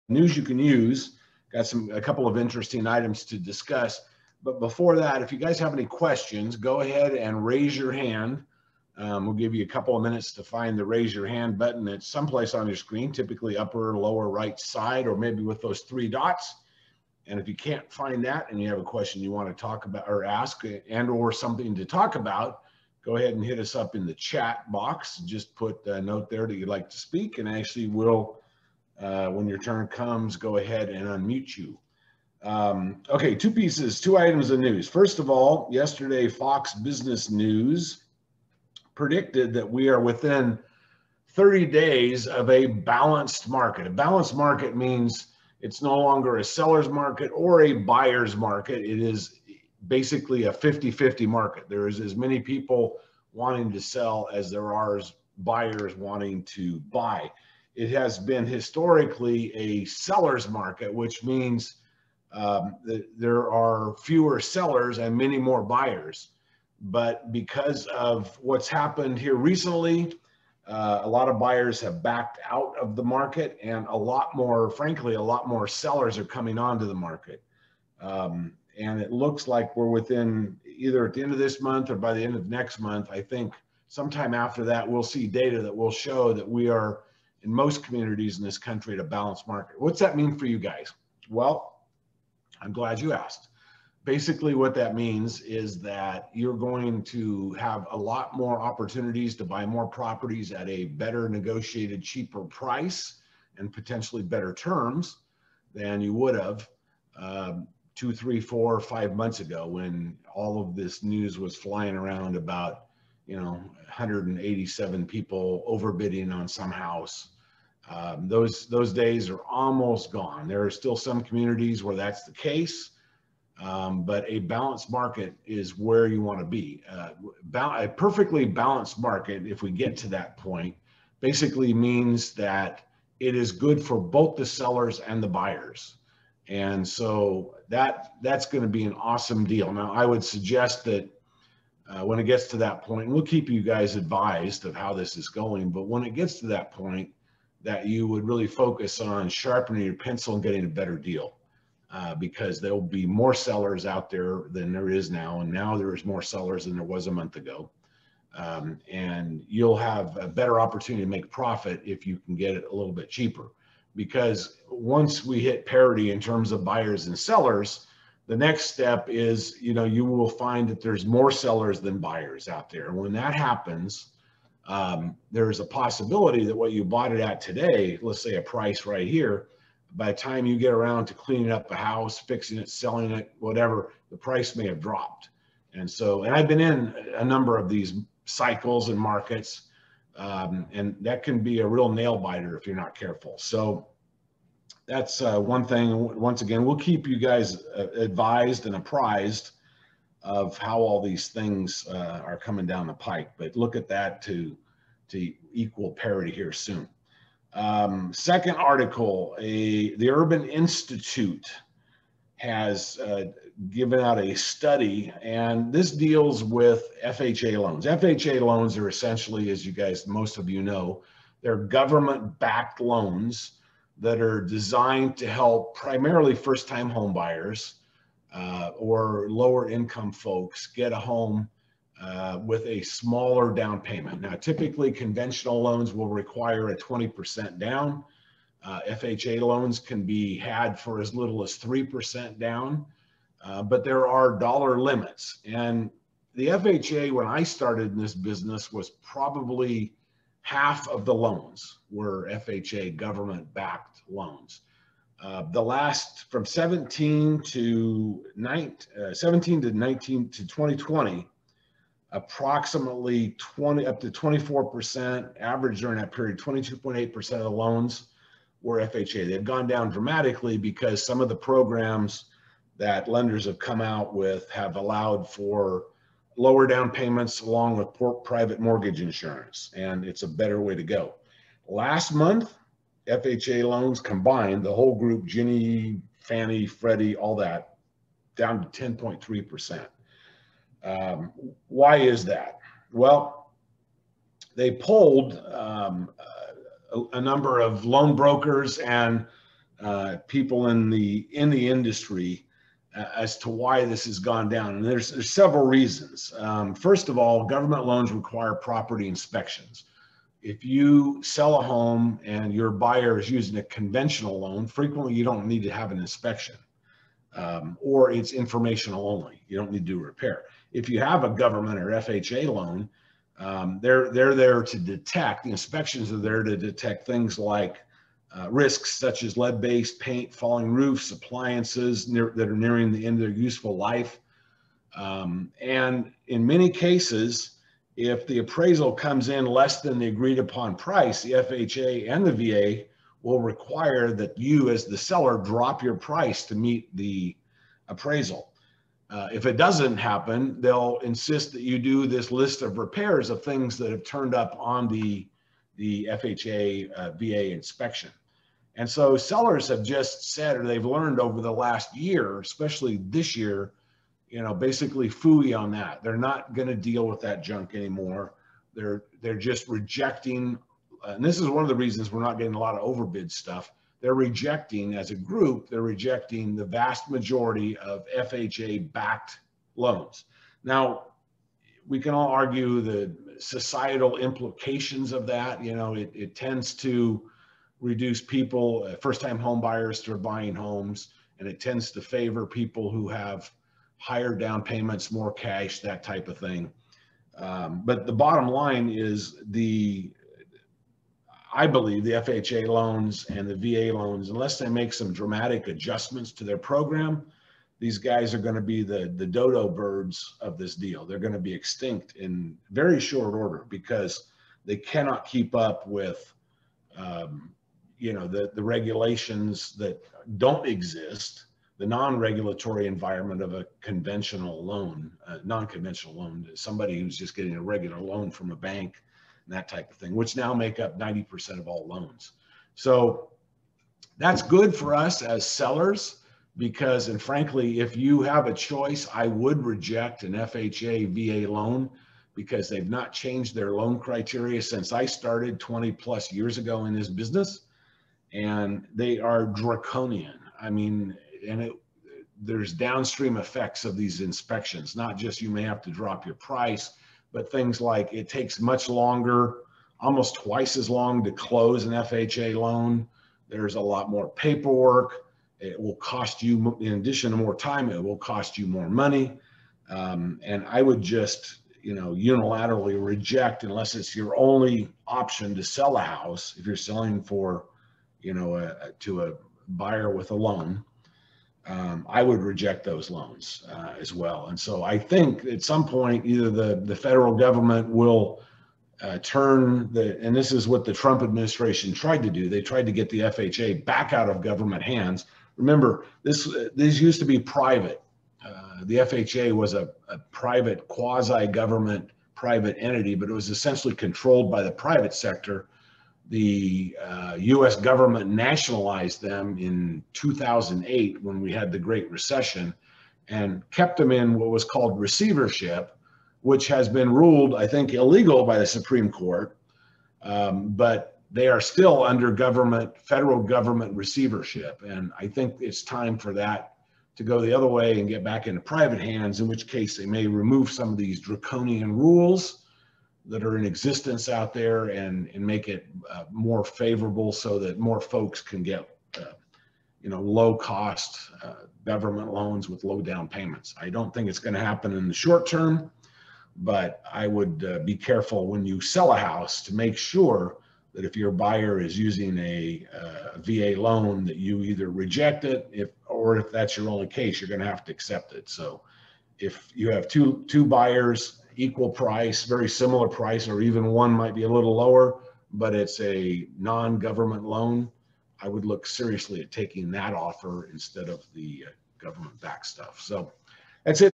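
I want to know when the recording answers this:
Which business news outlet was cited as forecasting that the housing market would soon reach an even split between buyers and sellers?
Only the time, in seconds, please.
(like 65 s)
36 s.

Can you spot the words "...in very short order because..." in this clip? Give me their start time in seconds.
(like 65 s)
412 s.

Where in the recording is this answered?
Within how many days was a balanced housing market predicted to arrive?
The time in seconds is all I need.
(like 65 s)
41 s.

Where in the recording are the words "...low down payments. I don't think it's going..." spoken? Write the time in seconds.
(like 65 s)
542 s.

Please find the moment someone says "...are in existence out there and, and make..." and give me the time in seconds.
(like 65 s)
533 s.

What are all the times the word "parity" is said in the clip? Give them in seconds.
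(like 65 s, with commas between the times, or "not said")
165 s, 205 s.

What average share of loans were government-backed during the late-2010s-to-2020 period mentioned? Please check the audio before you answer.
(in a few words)
22.8%.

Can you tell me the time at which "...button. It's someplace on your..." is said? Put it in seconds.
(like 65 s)
11 s.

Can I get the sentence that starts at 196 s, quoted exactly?
Once again, we'll keep you guys uh, advised and apprised of how all these things uh, are coming down the pike.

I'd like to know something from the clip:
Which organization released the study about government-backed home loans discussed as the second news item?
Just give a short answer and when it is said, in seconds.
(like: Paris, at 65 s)
Urban Institute, at 210 s.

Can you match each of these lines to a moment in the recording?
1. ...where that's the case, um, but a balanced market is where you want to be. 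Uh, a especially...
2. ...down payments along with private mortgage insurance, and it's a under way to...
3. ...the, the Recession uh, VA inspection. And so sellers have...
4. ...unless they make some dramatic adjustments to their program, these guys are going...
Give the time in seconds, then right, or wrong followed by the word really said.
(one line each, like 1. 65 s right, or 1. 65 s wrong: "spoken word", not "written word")
1. 121 s wrong: "perfectly", not "especially"
2. 276 s wrong: "better", not "under"
3. 354 s wrong: "FHA", not "Recession"
4. 404 s right.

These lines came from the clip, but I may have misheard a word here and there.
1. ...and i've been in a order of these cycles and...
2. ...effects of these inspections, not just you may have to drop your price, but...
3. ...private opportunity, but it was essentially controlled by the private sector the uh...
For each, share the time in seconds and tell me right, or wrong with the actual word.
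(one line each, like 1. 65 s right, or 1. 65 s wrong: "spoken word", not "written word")
1. 186 s wrong: "number", not "order"
2. 453 s right
3. 502 s wrong: "entity", not "opportunity".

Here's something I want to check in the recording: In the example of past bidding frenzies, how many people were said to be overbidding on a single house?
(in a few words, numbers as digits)
187.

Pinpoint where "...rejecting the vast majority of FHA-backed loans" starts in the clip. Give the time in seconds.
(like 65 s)
375 s.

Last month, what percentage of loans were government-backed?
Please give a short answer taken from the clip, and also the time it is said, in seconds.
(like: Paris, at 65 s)
10.3%, at 288 s.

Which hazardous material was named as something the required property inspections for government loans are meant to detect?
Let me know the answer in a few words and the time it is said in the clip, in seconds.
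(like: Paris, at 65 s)
lead-based paint, at 329 s.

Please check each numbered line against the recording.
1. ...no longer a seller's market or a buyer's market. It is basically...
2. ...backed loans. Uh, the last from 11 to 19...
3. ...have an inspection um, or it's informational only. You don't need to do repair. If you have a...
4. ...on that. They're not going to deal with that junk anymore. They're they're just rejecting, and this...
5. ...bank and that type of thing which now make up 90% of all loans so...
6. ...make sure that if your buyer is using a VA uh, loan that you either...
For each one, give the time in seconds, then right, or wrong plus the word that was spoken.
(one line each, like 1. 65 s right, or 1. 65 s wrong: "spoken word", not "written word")
1. 45 s right
2. 253 s wrong: "17", not "11"
3. 315 s right
4. 365 s right
5. 428 s right
6. 549 s right.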